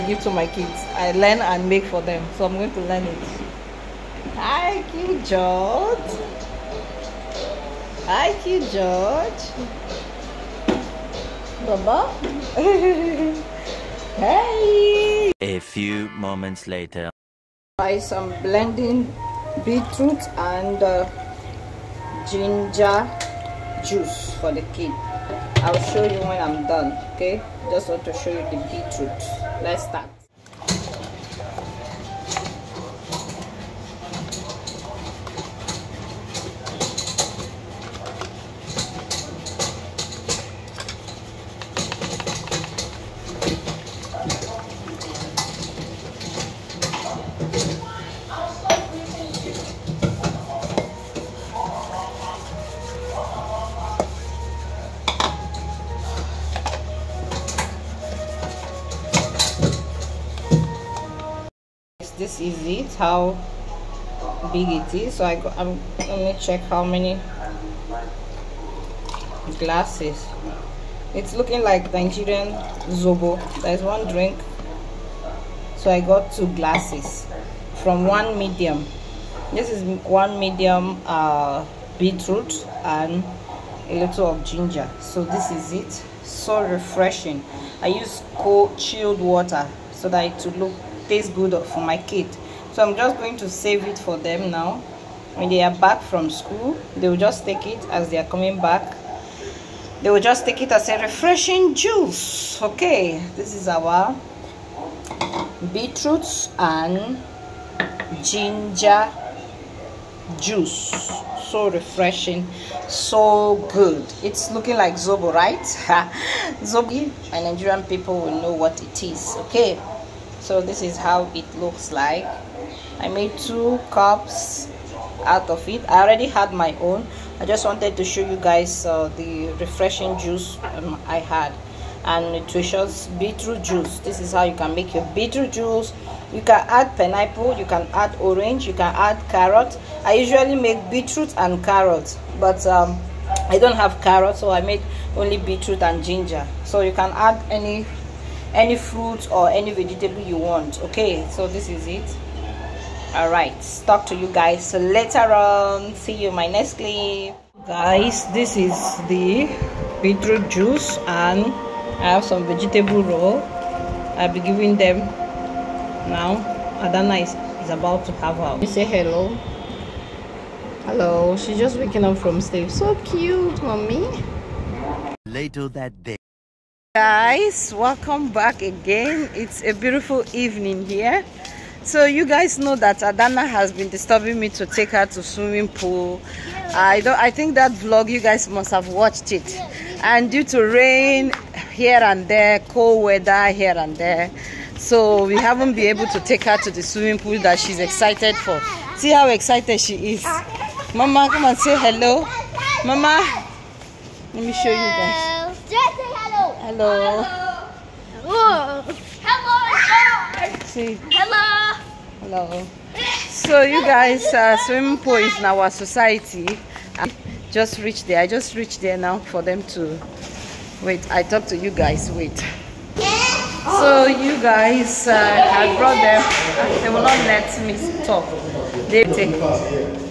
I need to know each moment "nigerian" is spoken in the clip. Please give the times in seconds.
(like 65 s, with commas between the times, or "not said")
71 s, 117 s.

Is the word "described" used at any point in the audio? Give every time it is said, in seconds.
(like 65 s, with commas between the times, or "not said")
not said.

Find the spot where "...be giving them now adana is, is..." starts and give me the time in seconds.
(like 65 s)
164 s.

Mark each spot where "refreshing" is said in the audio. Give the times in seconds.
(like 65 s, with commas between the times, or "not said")
86 s, 101 s, 111 s, 129 s.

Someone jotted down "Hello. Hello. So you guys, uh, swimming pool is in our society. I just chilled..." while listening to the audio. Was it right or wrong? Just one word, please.
wrong.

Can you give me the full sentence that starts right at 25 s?
I'll show you when I'm done, okay?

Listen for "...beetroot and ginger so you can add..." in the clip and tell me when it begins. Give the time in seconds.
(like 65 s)
145 s.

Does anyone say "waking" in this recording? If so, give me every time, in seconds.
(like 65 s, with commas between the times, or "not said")
171 s.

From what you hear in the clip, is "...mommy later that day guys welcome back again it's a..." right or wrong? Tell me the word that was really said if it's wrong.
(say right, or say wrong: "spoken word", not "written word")
right.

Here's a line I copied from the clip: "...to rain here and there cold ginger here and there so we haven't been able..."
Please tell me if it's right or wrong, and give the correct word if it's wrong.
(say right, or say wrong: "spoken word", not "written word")
wrong: "weather", not "ginger".